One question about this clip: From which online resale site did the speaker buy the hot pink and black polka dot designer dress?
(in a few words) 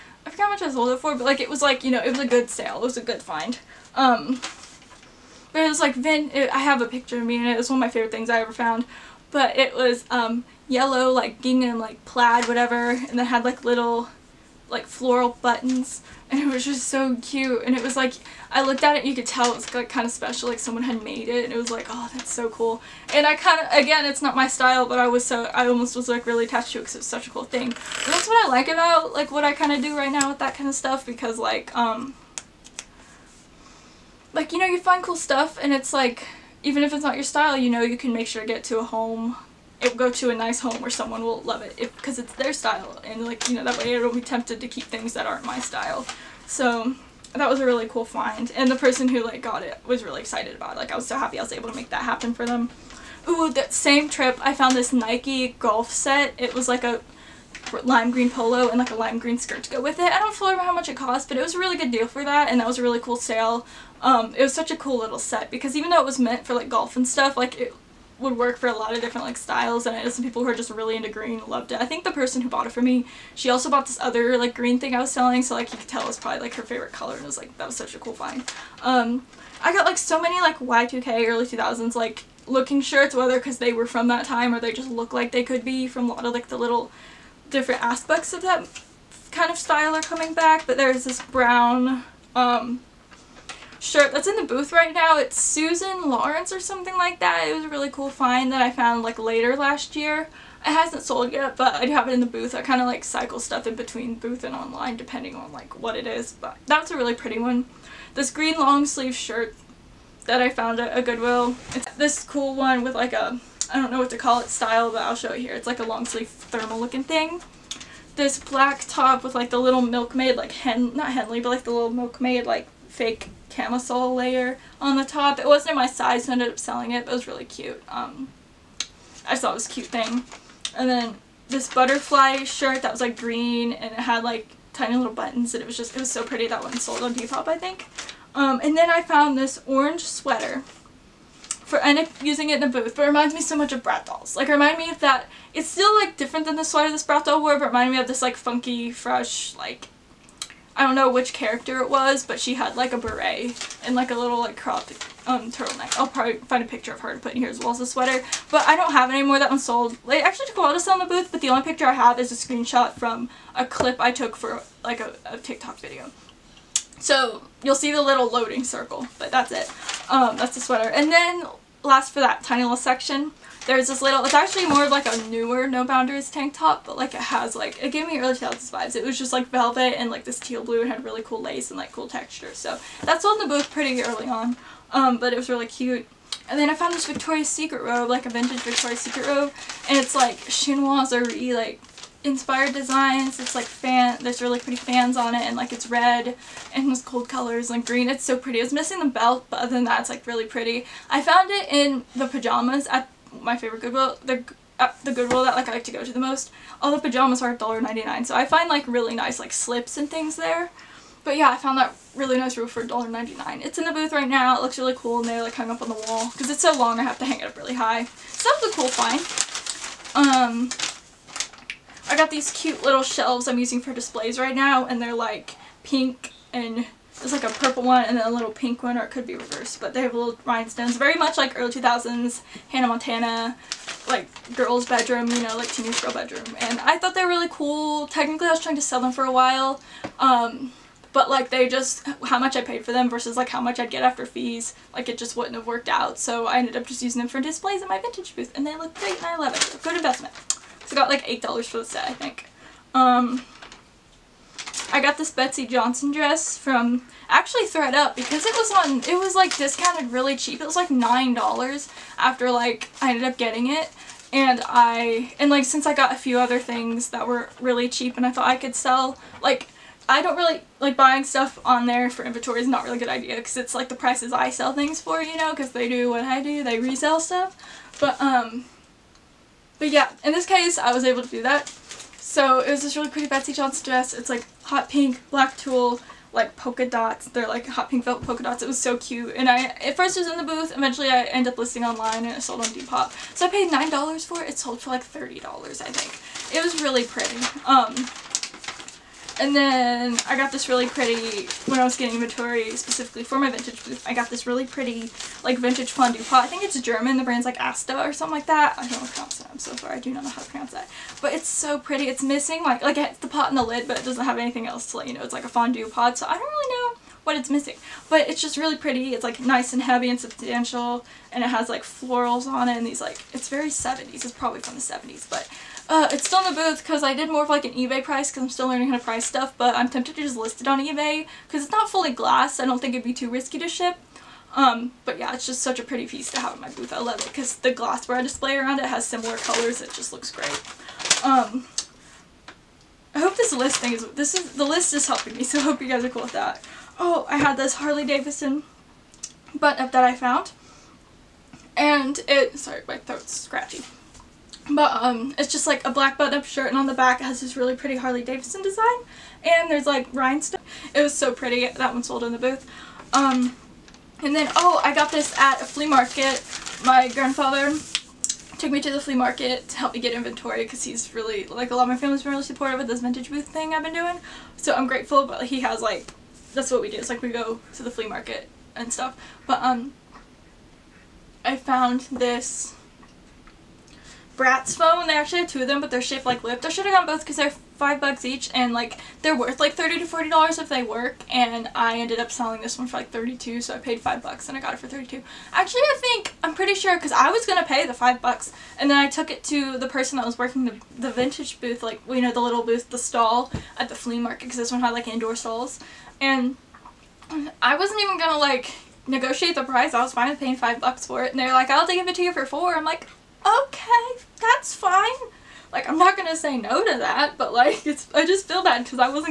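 thredUP.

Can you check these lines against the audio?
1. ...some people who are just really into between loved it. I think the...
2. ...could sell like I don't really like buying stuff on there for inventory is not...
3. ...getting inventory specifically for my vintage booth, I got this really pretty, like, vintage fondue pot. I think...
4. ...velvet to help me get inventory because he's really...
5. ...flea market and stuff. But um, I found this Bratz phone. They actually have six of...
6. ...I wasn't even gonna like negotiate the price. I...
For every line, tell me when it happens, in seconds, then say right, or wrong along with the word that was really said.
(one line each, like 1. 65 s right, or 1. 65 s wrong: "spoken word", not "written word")
1. 70 s wrong: "green", not "between"
2. 268 s right
3. 301 s right
4. 369 s wrong: "market", not "velvet"
5. 377 s wrong: "two", not "six"
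6. 407 s right.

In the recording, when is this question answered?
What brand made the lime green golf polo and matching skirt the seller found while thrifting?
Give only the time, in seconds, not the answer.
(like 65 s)
54 s.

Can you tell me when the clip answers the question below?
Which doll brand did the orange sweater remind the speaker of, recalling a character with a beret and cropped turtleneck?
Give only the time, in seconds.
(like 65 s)
143 s.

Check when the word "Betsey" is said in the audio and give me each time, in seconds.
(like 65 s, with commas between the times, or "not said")
255 s, 283 s.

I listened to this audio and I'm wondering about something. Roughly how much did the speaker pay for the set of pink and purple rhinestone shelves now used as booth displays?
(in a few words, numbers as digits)
$8.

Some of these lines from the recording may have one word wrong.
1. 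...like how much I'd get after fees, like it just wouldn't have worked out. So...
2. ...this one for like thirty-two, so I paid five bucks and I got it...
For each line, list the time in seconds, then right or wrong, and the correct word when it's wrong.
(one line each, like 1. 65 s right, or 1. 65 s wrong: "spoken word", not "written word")
1. 243 s right
2. 392 s right.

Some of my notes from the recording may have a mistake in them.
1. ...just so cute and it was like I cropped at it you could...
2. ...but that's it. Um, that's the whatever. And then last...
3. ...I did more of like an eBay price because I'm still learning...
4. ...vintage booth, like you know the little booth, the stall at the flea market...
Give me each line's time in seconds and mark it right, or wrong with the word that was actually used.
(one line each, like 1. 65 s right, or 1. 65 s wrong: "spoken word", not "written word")
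1. 16 s wrong: "looked", not "cropped"
2. 169 s wrong: "sweater", not "whatever"
3. 327 s right
4. 401 s right.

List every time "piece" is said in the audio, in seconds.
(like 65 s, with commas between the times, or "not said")
336 s.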